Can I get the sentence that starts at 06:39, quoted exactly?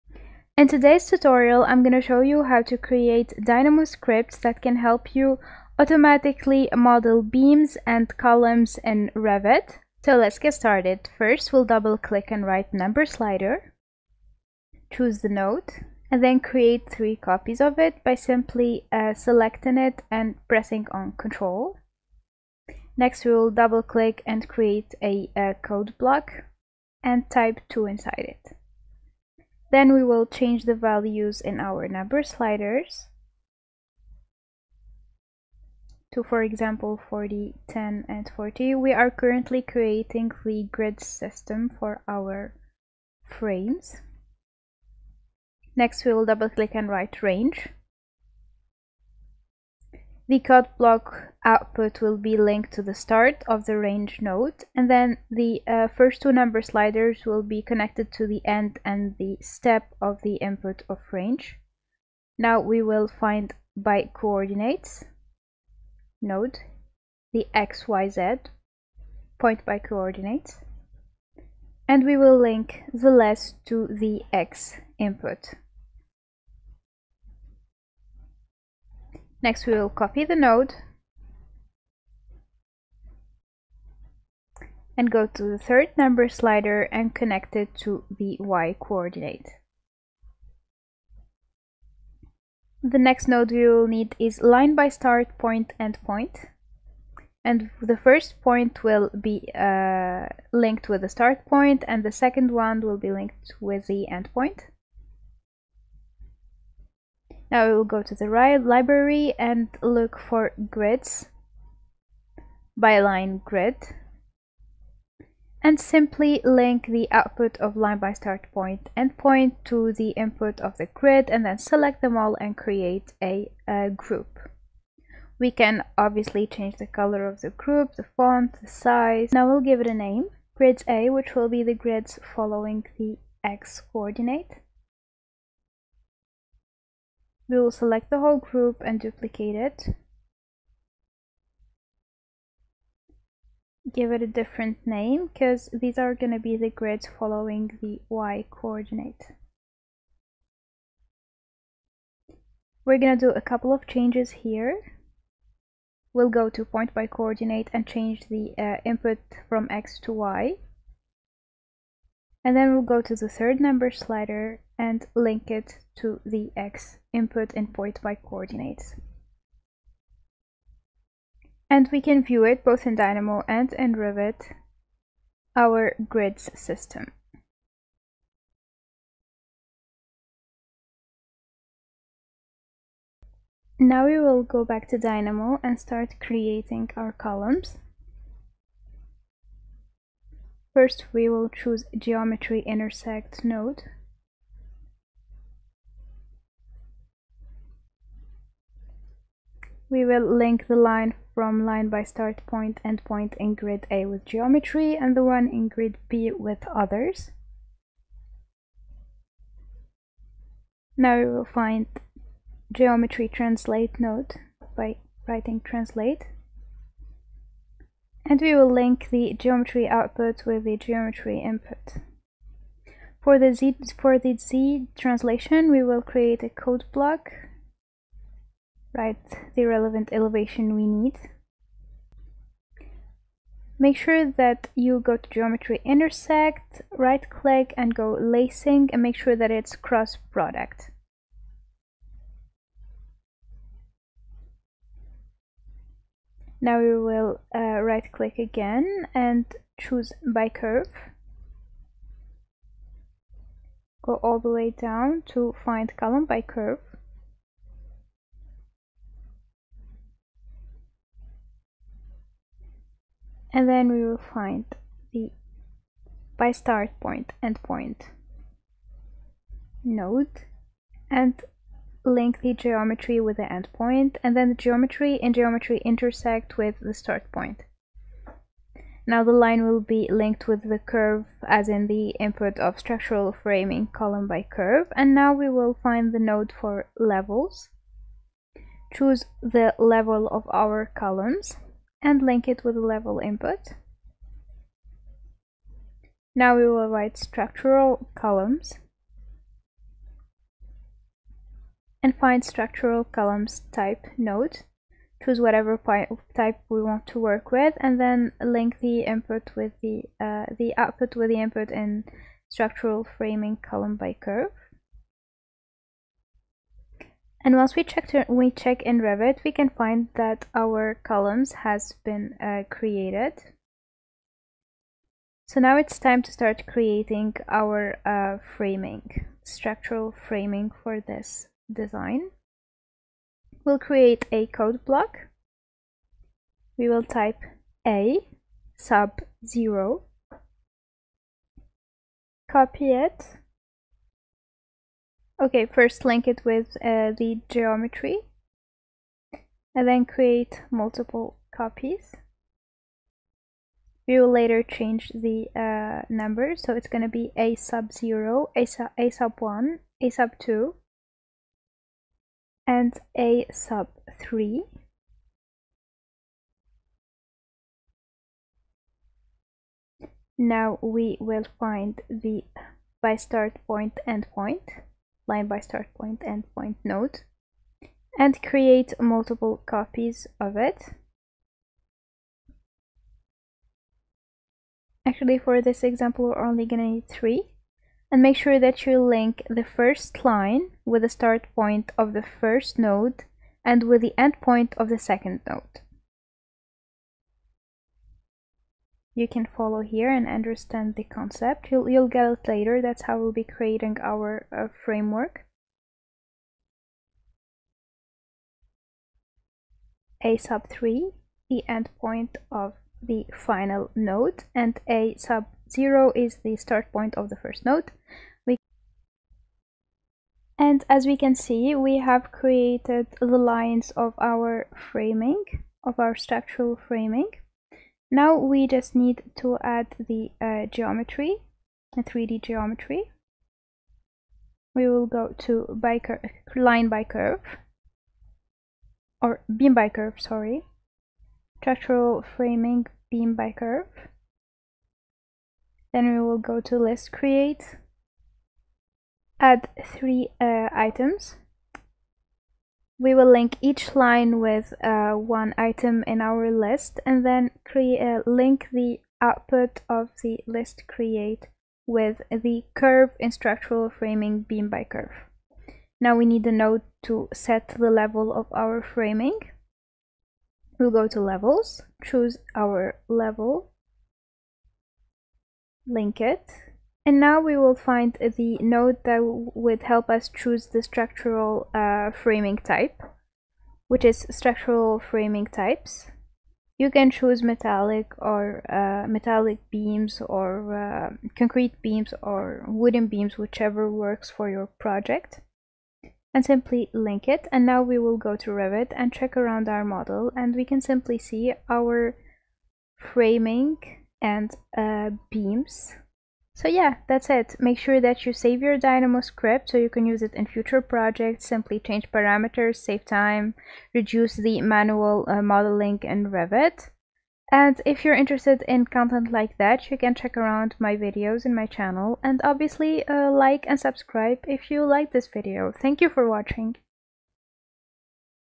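you can follow here and understand the concept.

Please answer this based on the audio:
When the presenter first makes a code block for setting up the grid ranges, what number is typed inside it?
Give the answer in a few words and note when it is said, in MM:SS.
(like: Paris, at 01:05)
2, at 00:27.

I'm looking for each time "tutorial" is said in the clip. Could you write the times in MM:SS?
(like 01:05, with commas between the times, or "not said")
00:01.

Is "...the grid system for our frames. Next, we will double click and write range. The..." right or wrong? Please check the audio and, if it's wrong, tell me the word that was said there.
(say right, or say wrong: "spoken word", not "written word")
right.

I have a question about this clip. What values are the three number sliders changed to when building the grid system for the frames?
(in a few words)
40, 10, and 40.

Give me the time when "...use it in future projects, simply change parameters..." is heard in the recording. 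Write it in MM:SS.
08:30.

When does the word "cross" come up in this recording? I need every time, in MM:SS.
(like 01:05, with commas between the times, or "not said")
03:59.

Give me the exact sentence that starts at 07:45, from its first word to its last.
Now we need a node to set the level of our framing.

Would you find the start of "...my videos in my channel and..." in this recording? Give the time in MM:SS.
08:40.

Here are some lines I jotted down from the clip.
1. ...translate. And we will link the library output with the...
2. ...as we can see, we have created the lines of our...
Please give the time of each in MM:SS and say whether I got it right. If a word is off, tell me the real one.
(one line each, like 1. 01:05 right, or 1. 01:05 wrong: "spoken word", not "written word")
1. 03:35 wrong: "geometry", not "library"
2. 07:00 right.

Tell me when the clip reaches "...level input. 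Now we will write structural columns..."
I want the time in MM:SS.
04:52.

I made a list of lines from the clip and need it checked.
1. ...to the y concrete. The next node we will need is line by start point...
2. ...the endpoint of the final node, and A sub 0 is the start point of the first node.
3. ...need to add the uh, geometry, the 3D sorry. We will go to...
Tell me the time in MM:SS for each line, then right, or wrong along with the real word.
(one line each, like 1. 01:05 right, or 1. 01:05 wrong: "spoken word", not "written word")
1. 01:27 wrong: "coordinate", not "concrete"
2. 06:51 right
3. 07:08 wrong: "geometry", not "sorry".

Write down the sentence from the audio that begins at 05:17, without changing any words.
And once we check, we check in Revit, we can find that our columns has been uh, created.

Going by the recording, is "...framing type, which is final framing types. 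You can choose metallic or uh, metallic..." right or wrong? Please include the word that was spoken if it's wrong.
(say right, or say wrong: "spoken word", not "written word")
wrong: "structural", not "final".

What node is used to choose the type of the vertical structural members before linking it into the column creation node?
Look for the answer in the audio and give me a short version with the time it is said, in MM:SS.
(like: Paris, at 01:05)
structural columns type, at 05:02.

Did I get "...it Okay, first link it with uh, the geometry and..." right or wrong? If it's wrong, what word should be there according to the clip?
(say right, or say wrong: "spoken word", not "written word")
right.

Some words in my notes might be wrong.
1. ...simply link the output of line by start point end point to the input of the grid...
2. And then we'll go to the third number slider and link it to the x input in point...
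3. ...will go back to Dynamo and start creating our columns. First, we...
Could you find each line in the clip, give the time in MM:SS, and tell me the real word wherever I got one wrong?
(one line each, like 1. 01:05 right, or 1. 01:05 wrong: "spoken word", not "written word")
1. 01:55 right
2. 02:42 right
3. 03:04 right.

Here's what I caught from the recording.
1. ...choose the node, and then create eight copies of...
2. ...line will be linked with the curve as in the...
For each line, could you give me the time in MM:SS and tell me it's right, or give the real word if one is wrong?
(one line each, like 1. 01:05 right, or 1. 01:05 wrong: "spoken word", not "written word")
1. 00:14 wrong: "three", not "eight"
2. 04:39 right.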